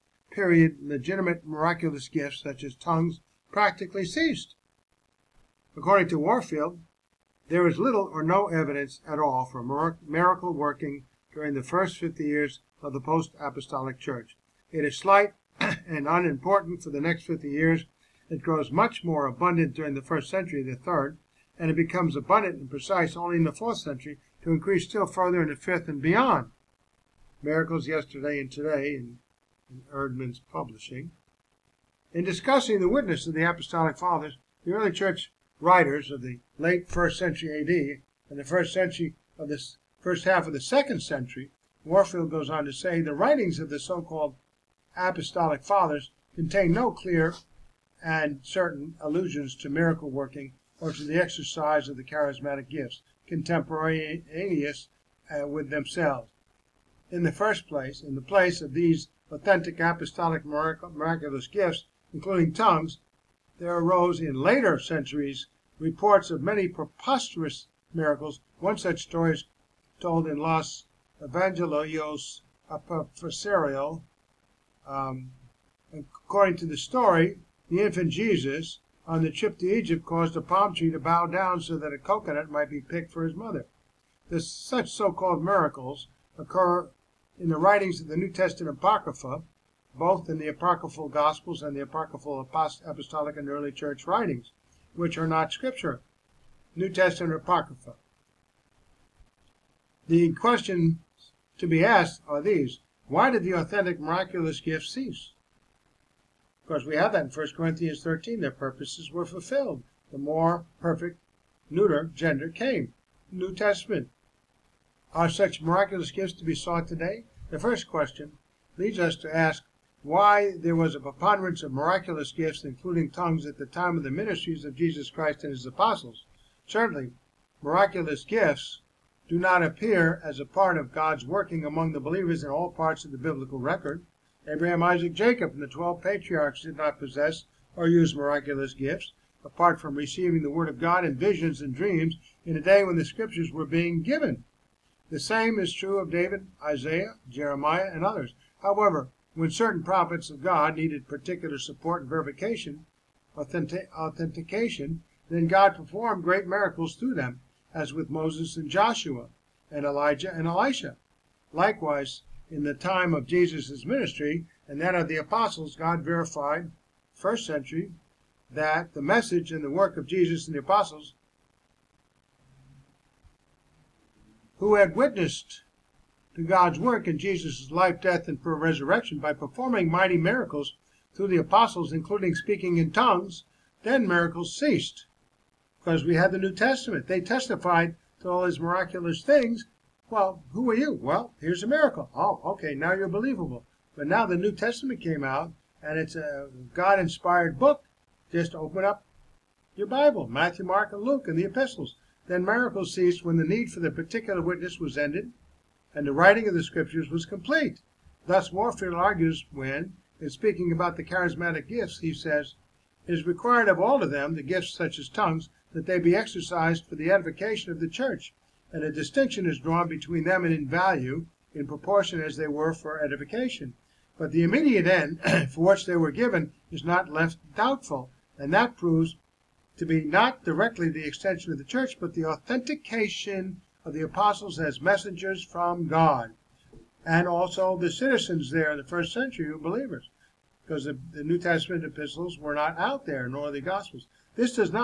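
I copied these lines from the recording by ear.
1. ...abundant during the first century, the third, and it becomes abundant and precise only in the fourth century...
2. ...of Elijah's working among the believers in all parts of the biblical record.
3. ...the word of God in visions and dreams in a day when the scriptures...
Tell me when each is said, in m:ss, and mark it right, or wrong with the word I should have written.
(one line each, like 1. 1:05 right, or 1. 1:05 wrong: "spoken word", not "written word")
1. 0:19 right
2. 2:10 wrong: "God", not "Elijah"
3. 2:20 right.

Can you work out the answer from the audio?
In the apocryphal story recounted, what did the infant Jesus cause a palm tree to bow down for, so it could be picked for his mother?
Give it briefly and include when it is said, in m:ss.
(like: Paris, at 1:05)
a coconut, at 1:21.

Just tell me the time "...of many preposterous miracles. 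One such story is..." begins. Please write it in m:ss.
1:06.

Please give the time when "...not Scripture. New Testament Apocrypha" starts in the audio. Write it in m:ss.
1:35.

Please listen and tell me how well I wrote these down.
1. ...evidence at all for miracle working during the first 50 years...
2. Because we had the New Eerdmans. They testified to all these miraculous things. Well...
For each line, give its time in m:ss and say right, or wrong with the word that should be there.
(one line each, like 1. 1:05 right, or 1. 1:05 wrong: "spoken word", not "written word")
1. 0:08 right
2. 3:05 wrong: "Testament", not "Eerdmans".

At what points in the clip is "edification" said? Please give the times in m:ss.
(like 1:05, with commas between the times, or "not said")
3:37, 3:43.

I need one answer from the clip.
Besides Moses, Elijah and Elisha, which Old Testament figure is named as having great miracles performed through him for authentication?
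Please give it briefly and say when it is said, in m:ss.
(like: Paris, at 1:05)
Joshua, at 2:38.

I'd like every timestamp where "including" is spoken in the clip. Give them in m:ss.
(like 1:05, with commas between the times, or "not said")
1:02, 2:02, 3:01.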